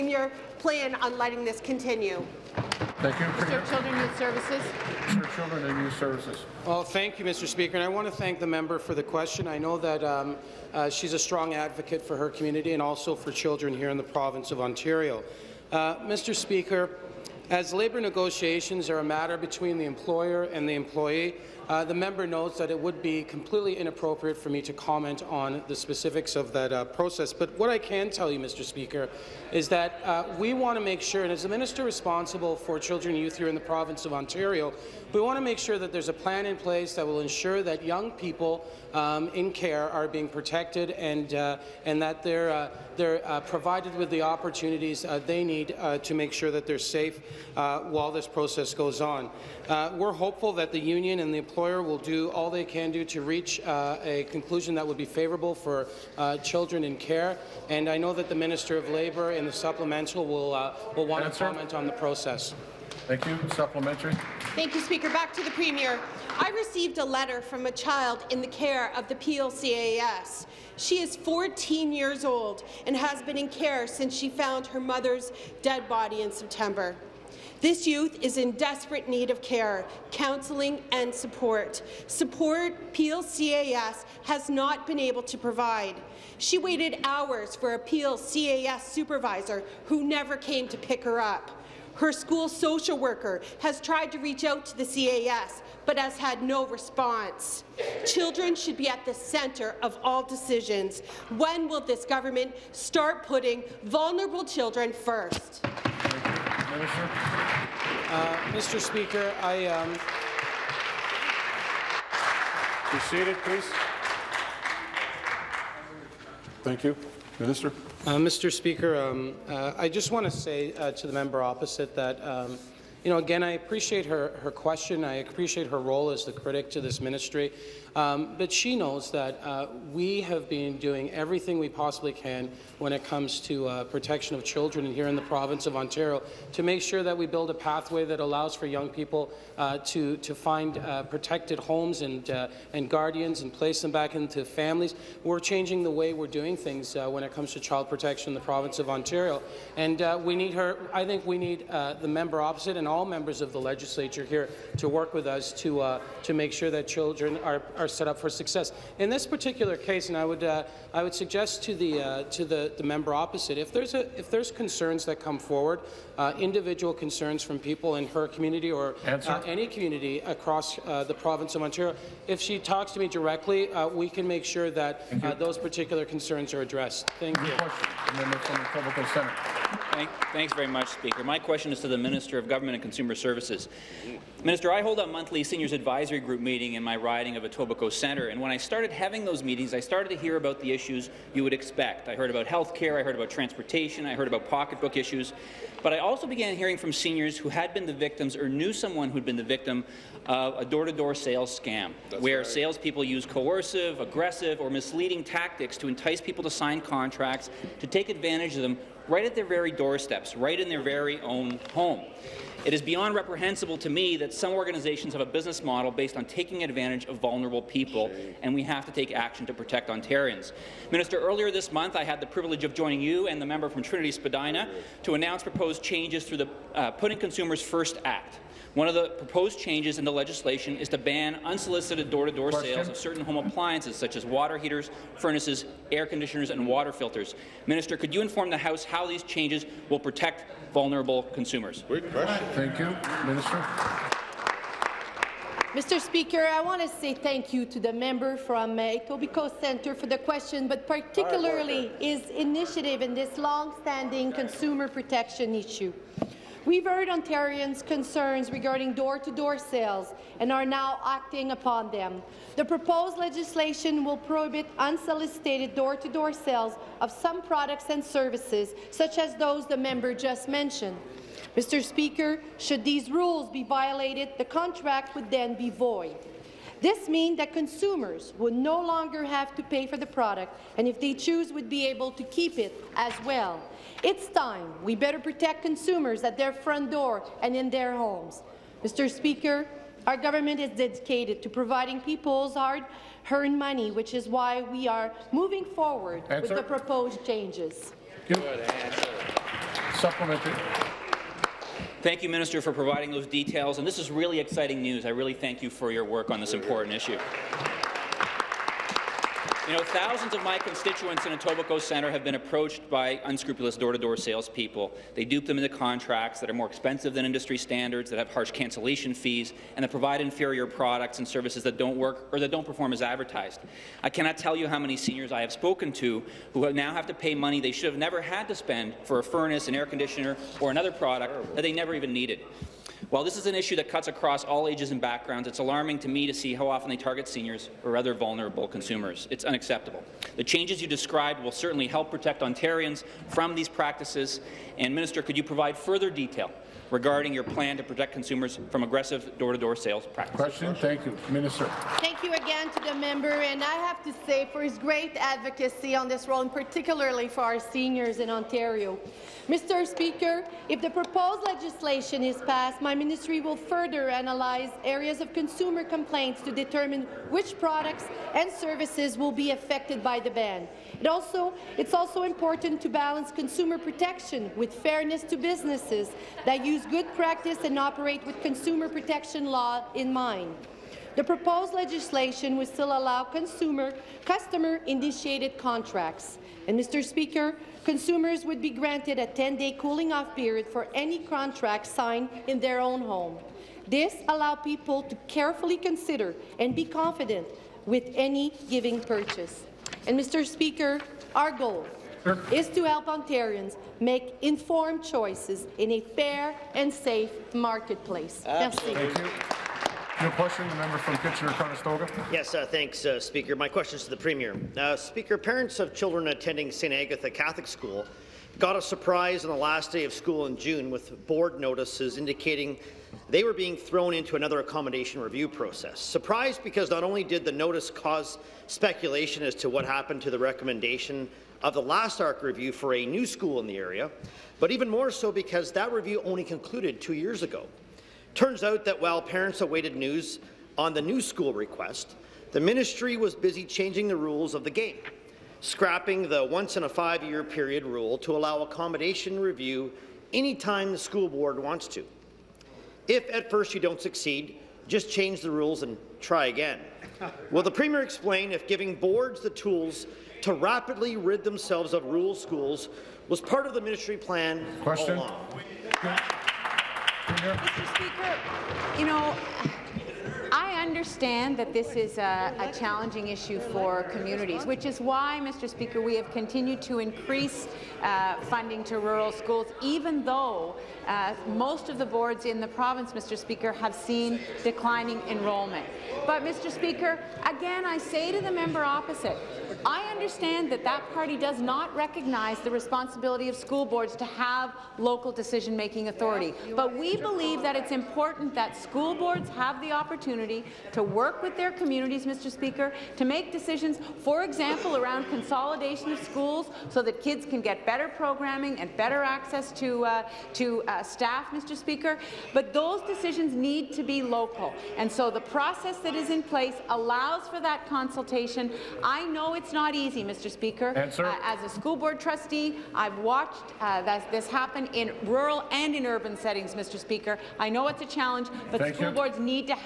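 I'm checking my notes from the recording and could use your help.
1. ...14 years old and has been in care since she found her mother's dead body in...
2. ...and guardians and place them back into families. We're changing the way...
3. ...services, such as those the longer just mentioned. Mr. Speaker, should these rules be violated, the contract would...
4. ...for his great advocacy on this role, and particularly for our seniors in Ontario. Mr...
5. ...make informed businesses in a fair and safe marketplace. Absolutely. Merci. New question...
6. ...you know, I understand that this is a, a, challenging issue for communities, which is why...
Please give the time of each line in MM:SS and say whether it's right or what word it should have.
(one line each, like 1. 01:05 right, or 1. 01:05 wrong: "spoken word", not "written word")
1. 01:11 right
2. 02:22 right
3. 04:28 wrong: "member", not "longer"
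4. 05:54 right
5. 06:43 wrong: "choices", not "businesses"
6. 07:48 right.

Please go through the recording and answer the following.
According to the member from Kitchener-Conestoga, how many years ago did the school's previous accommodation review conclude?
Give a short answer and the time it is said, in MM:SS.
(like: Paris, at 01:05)
2, at 07:17.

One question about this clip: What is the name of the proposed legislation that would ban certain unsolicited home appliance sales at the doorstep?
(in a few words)
Putting Consumers First Act.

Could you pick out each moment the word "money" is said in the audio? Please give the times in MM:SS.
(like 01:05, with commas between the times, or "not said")
04:53, 05:27.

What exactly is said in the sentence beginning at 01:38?
Children should be at the centre of all decisions.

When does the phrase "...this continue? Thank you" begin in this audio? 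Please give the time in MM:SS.
00:01.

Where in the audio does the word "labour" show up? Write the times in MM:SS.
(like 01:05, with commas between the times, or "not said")
00:17, 00:58.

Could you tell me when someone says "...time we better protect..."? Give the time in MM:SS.
04:44.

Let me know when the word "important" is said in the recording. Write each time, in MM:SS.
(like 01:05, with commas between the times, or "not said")
05:06, 06:12, 08:17.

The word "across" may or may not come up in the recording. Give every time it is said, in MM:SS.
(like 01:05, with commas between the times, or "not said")
02:50, 05:34.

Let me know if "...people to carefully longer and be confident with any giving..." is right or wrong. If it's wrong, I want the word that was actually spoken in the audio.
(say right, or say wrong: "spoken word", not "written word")
wrong: "consider", not "longer".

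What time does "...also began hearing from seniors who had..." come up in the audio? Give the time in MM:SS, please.
03:15.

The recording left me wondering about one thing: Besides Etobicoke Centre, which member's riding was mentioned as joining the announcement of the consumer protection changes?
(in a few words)
Trinity Spadina.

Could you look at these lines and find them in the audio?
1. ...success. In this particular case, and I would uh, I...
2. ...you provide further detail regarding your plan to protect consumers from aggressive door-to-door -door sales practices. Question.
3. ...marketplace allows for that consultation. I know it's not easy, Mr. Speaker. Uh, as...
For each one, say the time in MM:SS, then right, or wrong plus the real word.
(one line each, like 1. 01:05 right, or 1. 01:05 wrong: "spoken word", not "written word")
1. 02:38 right
2. 05:45 right
3. 08:36 wrong: "place", not "marketplace".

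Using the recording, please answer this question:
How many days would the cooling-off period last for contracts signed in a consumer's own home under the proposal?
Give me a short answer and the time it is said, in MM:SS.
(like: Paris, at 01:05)
10, at 06:29.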